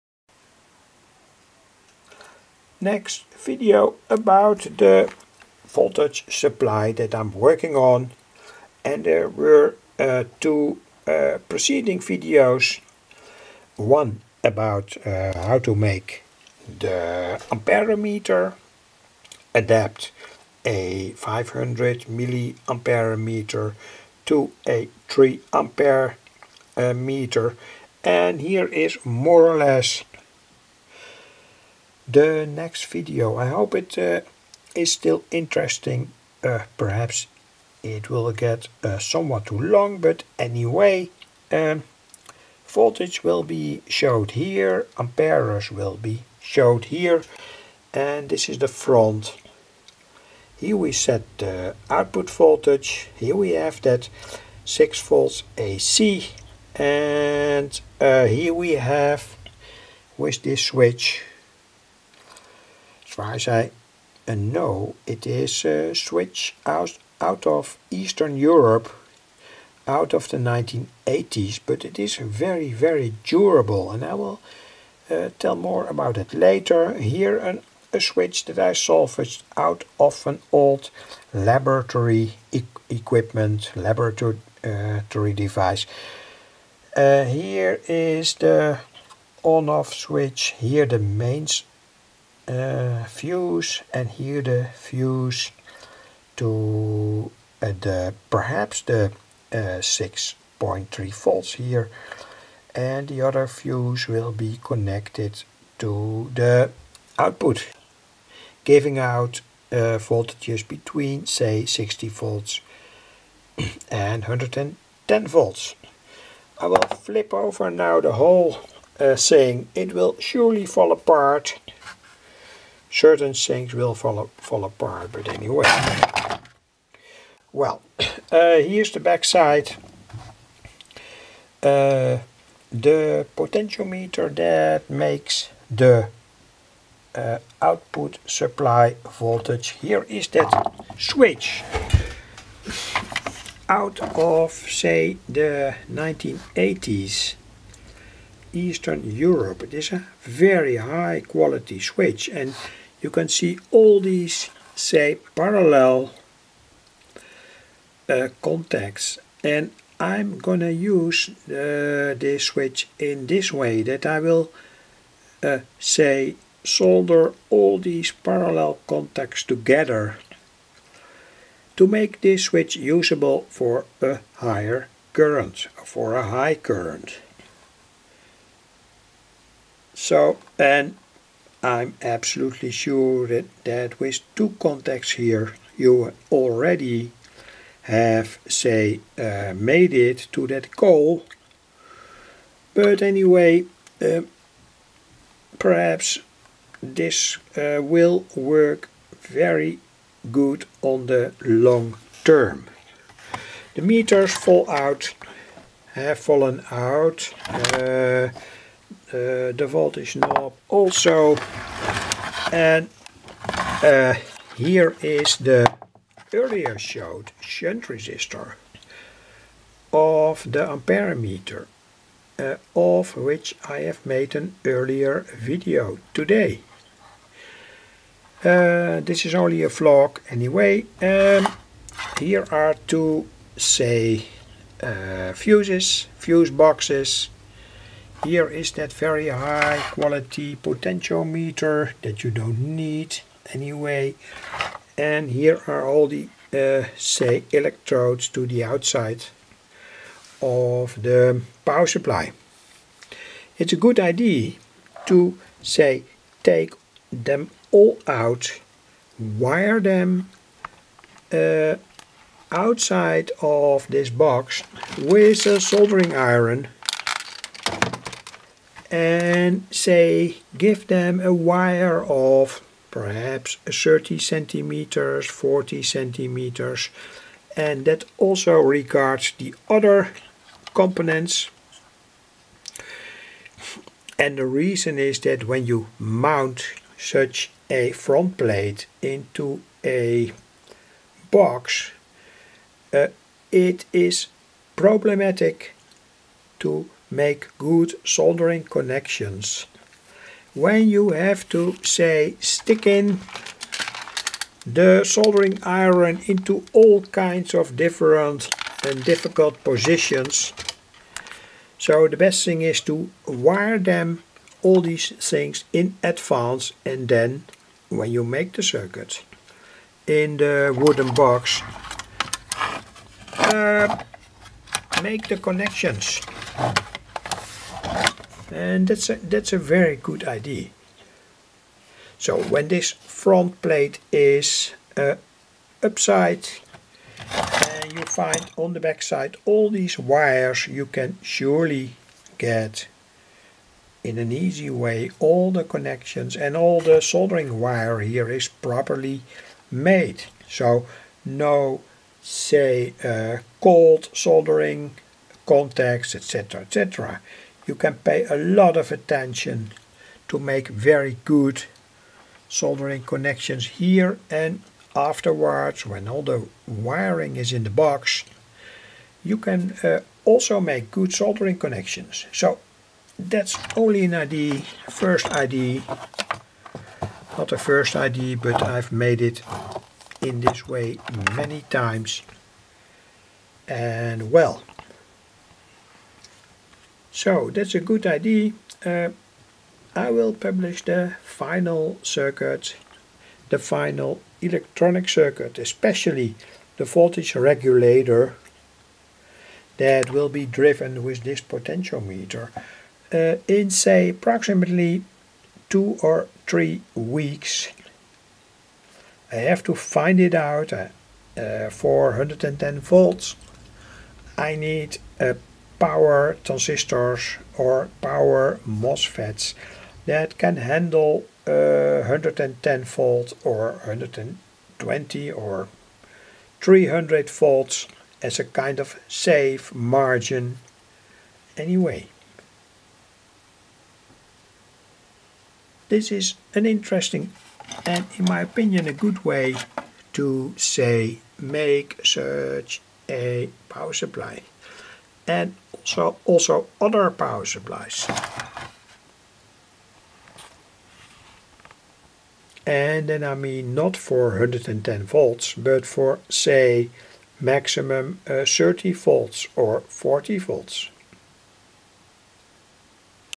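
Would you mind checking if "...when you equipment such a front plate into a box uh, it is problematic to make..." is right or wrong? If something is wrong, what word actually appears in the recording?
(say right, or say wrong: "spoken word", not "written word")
wrong: "mount", not "equipment".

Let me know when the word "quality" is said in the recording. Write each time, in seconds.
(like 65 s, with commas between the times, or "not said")
151 s, 239 s.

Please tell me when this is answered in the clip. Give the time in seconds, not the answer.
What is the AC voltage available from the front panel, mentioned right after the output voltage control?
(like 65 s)
54 s.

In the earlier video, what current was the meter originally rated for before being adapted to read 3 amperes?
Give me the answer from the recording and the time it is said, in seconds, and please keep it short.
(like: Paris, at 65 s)
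500 milliampere, at 21 s.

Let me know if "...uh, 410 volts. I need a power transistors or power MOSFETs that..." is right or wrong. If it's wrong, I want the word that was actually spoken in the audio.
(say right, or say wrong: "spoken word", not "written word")
right.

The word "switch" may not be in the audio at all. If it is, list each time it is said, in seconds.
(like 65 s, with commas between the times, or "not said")
60 s, 65 s, 77 s, 89 s, 140 s, 151 s, 162 s, 172 s.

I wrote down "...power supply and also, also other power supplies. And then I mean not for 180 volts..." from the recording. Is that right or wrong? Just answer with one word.
wrong.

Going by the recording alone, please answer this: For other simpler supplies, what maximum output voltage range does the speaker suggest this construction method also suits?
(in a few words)
30 or 40 volts.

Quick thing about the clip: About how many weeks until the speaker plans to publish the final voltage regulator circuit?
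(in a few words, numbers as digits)
two or three weeks.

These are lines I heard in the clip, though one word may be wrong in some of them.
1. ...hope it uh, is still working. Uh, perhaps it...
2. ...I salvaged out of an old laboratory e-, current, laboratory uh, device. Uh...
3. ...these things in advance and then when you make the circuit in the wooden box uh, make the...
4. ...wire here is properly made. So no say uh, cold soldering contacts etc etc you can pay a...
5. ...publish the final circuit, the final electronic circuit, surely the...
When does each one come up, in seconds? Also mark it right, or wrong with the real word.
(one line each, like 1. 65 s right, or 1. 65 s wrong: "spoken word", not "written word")
1. 33 s wrong: "interesting", not "working"
2. 78 s wrong: "equipment", not "current"
3. 314 s right
4. 347 s right
5. 390 s wrong: "especially", not "surely".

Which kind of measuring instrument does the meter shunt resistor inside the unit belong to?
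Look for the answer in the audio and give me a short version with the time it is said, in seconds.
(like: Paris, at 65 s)
amperemeter, at 220 s.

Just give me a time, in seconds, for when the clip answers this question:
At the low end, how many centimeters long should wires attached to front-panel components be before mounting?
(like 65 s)
273 s.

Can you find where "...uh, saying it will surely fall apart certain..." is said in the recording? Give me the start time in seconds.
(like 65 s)
118 s.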